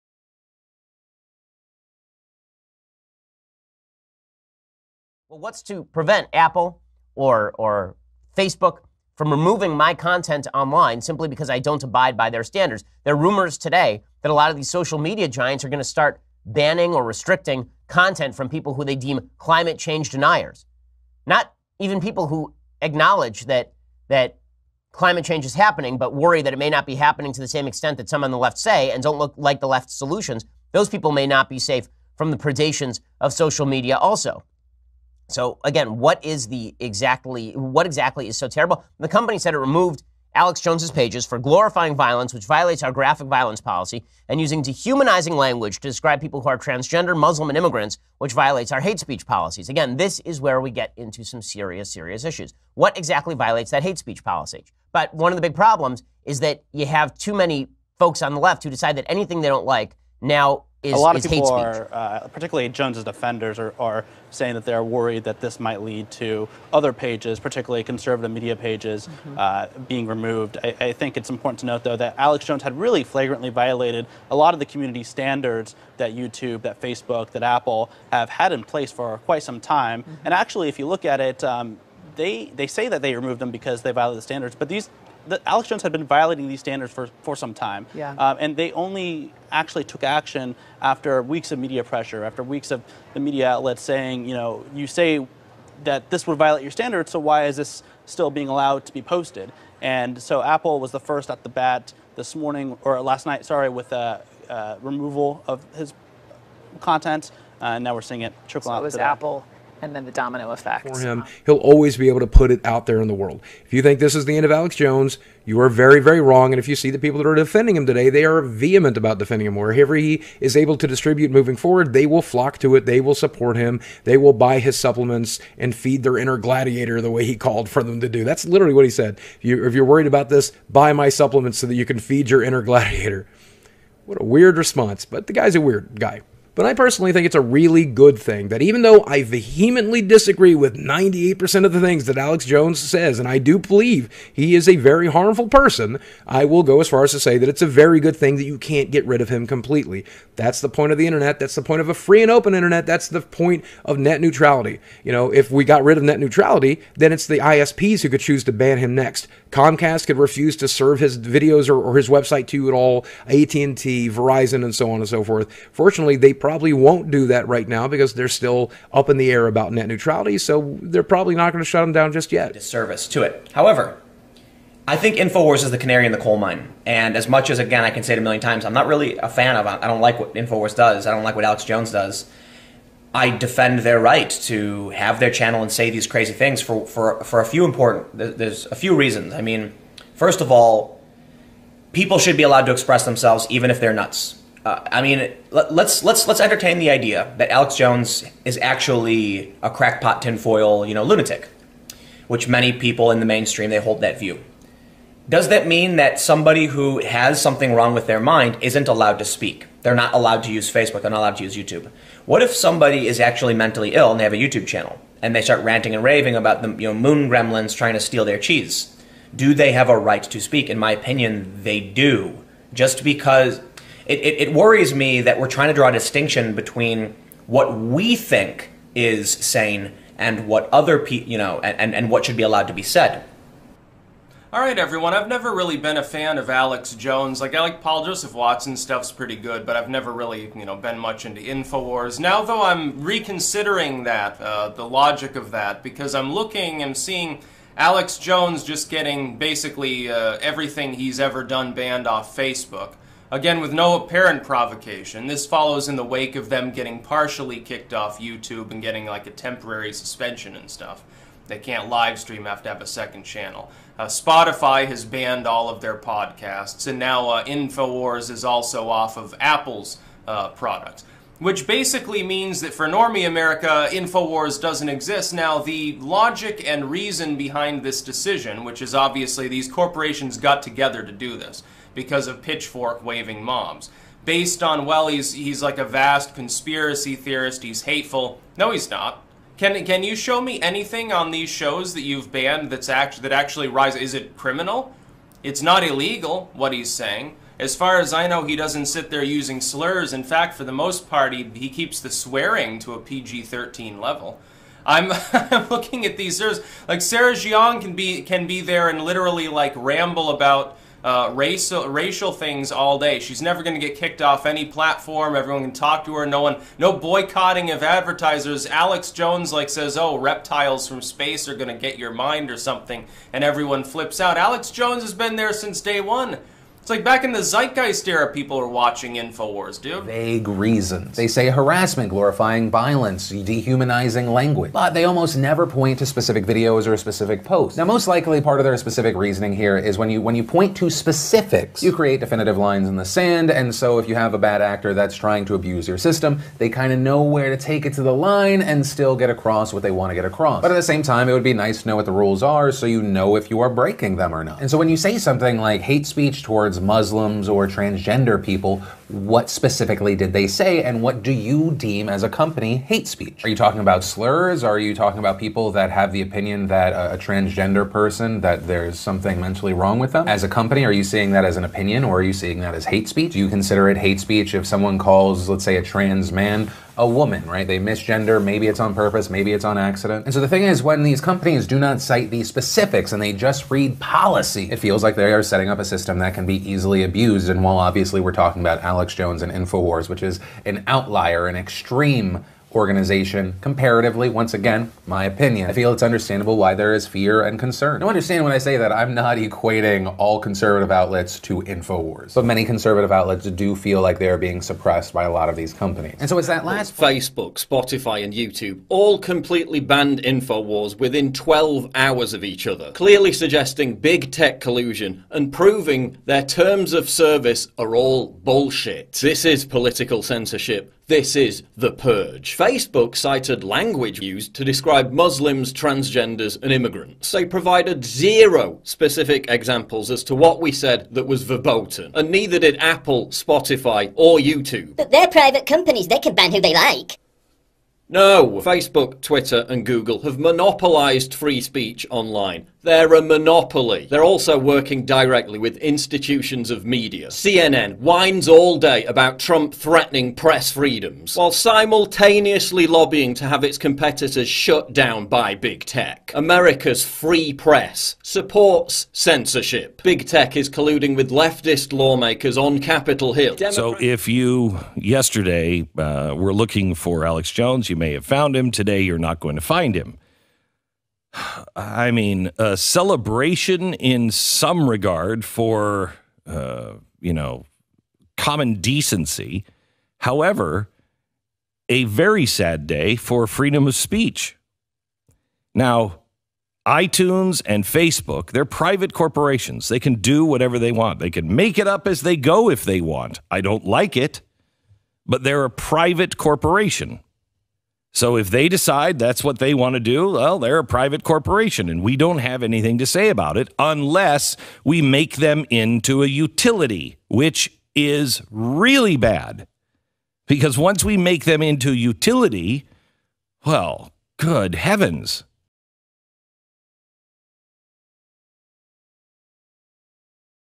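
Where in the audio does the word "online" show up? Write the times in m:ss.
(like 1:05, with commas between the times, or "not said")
0:10, 7:22.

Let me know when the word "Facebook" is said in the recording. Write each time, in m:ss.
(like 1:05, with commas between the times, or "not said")
0:08, 1:16, 3:30, 4:12, 6:46, 7:02, 7:18, 8:07.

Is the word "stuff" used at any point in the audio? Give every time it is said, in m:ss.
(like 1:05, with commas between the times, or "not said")
3:58, 4:20.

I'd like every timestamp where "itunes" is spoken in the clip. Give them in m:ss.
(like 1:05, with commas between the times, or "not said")
8:06.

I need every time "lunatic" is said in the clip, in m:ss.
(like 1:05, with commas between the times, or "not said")
3:21.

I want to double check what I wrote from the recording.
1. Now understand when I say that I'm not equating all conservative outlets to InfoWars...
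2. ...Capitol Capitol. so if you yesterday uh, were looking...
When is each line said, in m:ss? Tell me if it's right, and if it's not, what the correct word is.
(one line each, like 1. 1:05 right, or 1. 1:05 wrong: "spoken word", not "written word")
1. 6:37 right
2. 7:42 wrong: "Hill", not "Capitol".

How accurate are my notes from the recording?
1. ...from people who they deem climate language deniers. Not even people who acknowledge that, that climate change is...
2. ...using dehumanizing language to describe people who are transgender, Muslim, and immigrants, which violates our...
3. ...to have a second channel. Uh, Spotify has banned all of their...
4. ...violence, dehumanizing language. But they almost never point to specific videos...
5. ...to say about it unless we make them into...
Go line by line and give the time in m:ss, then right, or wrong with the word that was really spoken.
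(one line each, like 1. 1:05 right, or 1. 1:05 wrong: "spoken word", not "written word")
1. 0:18 wrong: "change", not "language"
2. 0:44 right
3. 4:22 right
4. 5:32 right
5. 8:22 right.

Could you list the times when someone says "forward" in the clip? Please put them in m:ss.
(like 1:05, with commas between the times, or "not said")
2:01.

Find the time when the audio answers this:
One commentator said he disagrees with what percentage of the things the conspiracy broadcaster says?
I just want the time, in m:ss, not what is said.
2:20.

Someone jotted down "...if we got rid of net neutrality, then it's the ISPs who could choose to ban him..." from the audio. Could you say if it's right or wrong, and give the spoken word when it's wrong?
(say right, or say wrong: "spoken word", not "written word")
right.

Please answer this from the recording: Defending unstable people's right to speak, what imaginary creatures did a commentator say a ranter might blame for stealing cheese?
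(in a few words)
moon gremlins.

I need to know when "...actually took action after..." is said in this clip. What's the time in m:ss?
1:29.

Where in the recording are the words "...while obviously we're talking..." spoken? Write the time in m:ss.
6:27.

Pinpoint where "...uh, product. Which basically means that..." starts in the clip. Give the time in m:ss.
4:30.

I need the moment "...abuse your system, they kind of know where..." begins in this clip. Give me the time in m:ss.
5:45.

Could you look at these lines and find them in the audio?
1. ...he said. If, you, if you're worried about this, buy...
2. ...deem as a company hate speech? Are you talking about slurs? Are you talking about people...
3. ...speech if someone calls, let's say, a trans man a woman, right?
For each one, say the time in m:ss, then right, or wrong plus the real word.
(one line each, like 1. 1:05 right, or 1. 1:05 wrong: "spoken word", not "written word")
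1. 2:08 right
2. 6:01 right
3. 6:14 right.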